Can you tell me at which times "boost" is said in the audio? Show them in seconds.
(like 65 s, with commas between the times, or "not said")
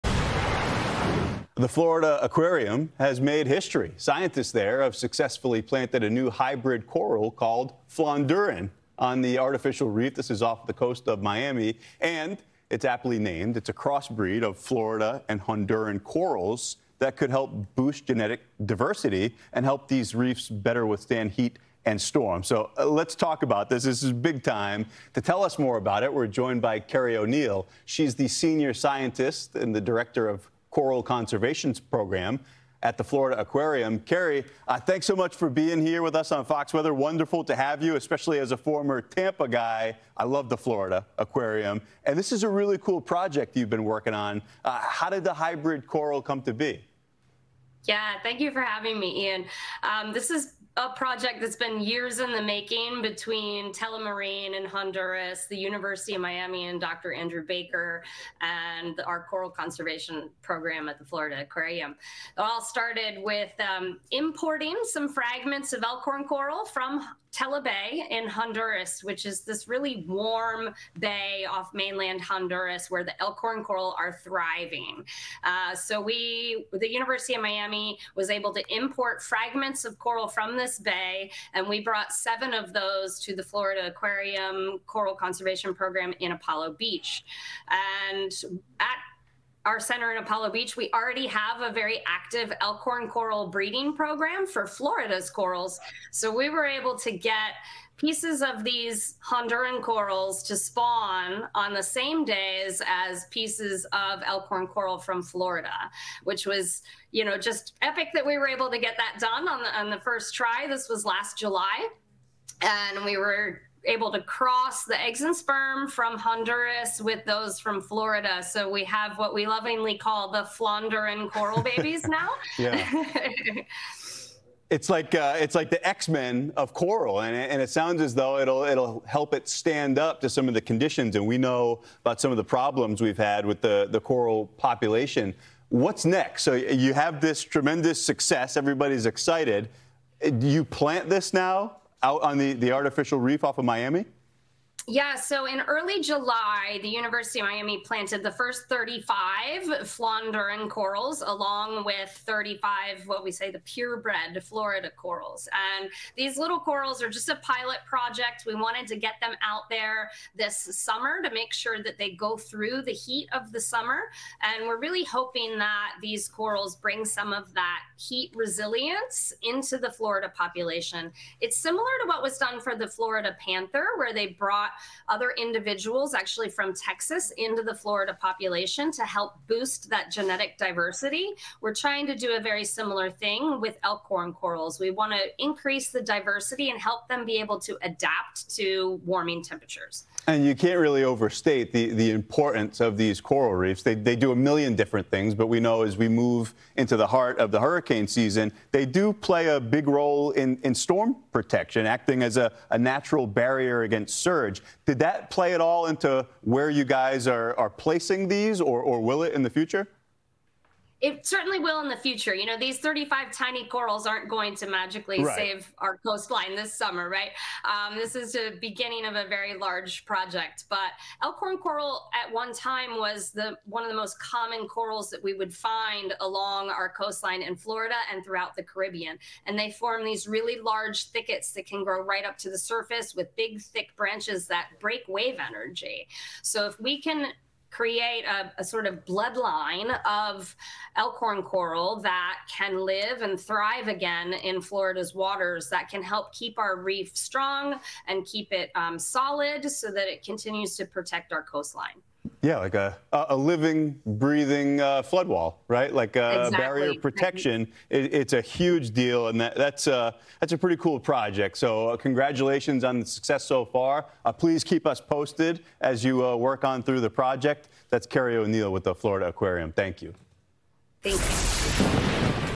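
17 s, 179 s.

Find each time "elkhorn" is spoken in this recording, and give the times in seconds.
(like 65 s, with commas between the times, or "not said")
65 s, 73 s, 92 s, 104 s, 183 s, 221 s, 240 s.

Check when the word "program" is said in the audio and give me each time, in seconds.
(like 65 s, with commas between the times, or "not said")
31 s, 60 s, 85 s, 93 s.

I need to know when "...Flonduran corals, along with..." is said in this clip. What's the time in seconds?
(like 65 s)
149 s.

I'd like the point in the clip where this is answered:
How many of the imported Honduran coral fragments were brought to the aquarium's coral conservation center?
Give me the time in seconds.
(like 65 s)
82 s.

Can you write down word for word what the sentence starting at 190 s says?
And you can't really overstate the, the importance of these coral reefs.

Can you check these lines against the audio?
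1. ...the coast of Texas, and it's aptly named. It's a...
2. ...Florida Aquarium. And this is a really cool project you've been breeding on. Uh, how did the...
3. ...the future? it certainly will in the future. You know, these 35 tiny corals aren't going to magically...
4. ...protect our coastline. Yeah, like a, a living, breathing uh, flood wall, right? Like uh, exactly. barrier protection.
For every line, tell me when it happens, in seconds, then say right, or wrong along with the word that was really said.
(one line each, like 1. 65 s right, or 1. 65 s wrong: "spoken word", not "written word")
1. 10 s wrong: "Miami", not "Texas"
2. 40 s wrong: "working", not "breeding"
3. 209 s right
4. 250 s right.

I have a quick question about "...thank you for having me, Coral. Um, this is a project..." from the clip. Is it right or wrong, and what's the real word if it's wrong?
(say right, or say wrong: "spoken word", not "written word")
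wrong: "Ian", not "Coral".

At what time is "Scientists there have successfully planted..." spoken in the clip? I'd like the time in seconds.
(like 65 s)
3 s.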